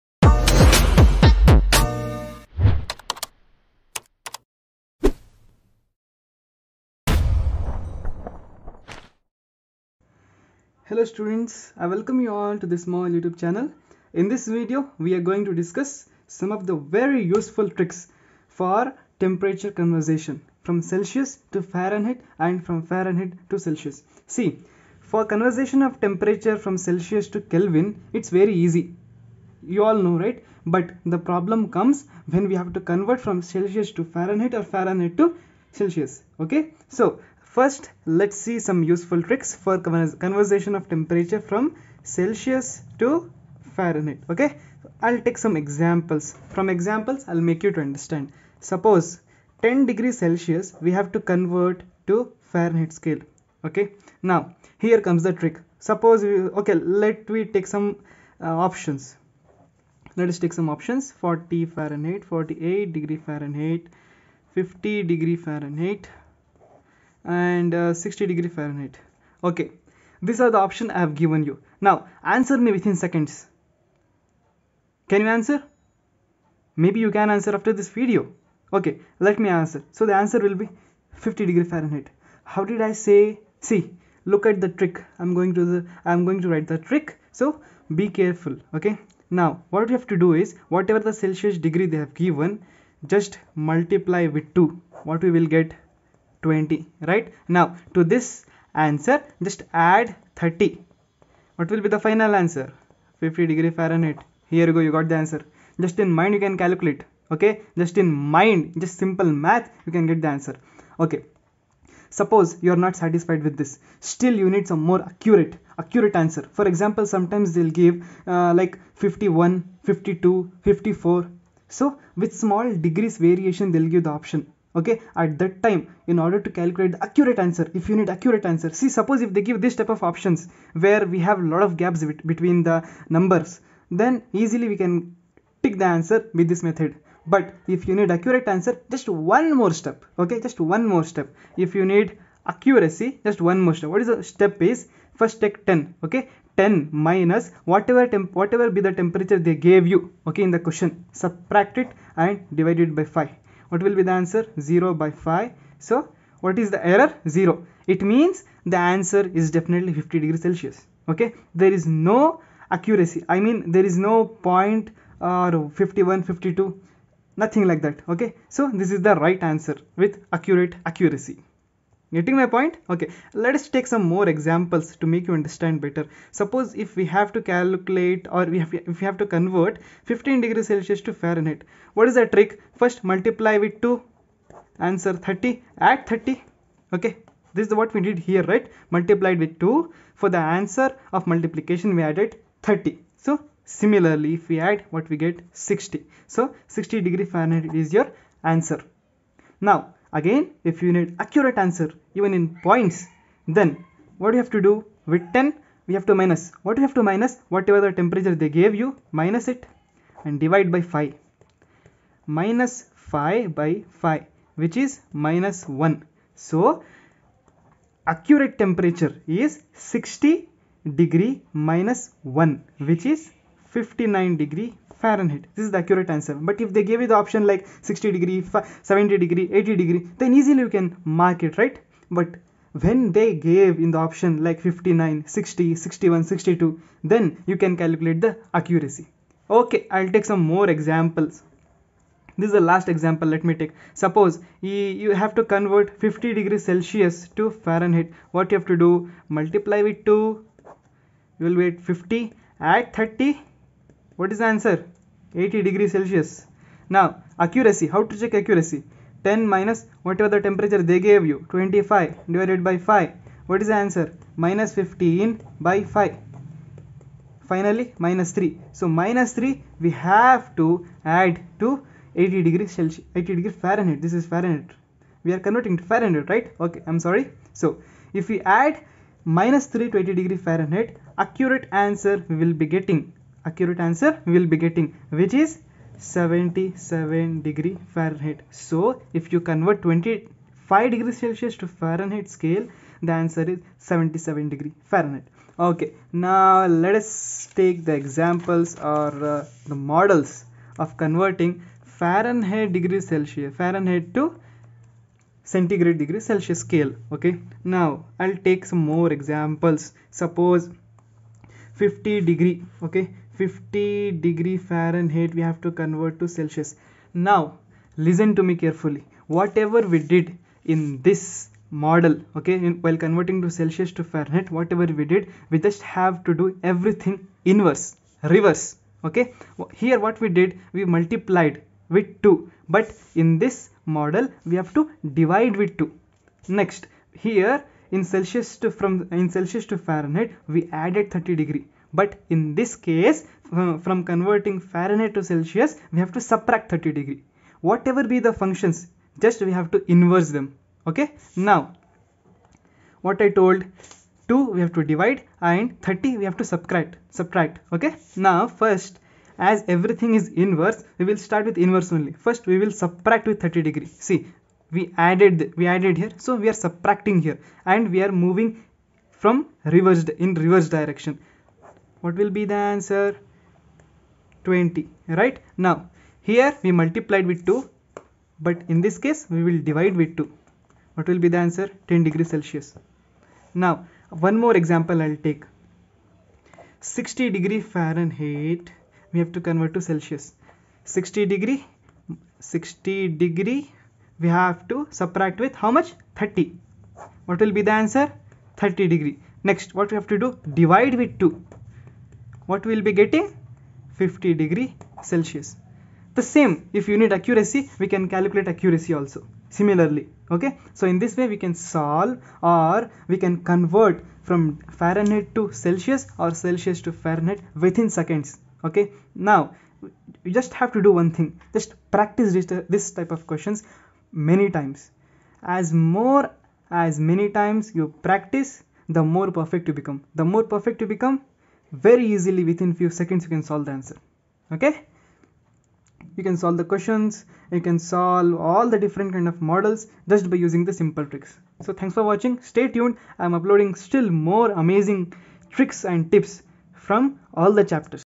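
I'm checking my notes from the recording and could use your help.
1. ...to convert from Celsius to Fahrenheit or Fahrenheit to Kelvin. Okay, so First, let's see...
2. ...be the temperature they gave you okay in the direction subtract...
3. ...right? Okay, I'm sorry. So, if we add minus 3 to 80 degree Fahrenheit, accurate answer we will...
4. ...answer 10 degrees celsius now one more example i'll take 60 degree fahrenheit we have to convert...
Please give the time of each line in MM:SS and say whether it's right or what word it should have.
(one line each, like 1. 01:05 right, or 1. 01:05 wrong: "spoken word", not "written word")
1. 00:32 wrong: "Celsius", not "Kelvin"
2. 02:28 wrong: "question", not "direction"
3. 04:36 right
4. 06:21 right.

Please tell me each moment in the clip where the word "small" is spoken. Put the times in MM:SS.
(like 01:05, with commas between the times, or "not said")
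00:12, 02:02.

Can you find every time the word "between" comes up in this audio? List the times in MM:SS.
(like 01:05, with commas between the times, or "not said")
02:12.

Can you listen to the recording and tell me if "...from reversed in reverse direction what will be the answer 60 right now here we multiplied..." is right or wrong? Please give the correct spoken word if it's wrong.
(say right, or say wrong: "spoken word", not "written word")
wrong: "20", not "60".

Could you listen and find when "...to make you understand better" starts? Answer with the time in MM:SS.
02:54.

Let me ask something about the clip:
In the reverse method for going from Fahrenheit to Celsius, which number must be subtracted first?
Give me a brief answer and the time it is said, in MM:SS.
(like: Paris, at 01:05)
30, at 05:46.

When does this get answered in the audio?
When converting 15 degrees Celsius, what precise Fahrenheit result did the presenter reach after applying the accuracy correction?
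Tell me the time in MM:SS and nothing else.
03:43.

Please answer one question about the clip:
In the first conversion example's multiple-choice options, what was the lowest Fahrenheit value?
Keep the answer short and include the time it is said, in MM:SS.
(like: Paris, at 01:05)
40 Fahrenheit, at 01:01.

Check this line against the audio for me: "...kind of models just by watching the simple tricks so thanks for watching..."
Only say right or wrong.
wrong.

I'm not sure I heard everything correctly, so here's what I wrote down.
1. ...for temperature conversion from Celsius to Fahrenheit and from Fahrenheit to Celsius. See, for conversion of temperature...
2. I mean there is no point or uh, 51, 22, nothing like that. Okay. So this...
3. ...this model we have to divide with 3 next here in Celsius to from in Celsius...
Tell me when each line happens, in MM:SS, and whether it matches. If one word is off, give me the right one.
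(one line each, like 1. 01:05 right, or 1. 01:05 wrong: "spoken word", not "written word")
1. 00:18 right
2. 02:43 wrong: "52", not "22"
3. 05:33 wrong: "2", not "3".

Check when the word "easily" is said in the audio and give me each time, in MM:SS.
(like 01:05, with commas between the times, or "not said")
02:14, 03:50, 07:12.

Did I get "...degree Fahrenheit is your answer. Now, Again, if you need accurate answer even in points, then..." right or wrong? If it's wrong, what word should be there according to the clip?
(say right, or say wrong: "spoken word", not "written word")
right.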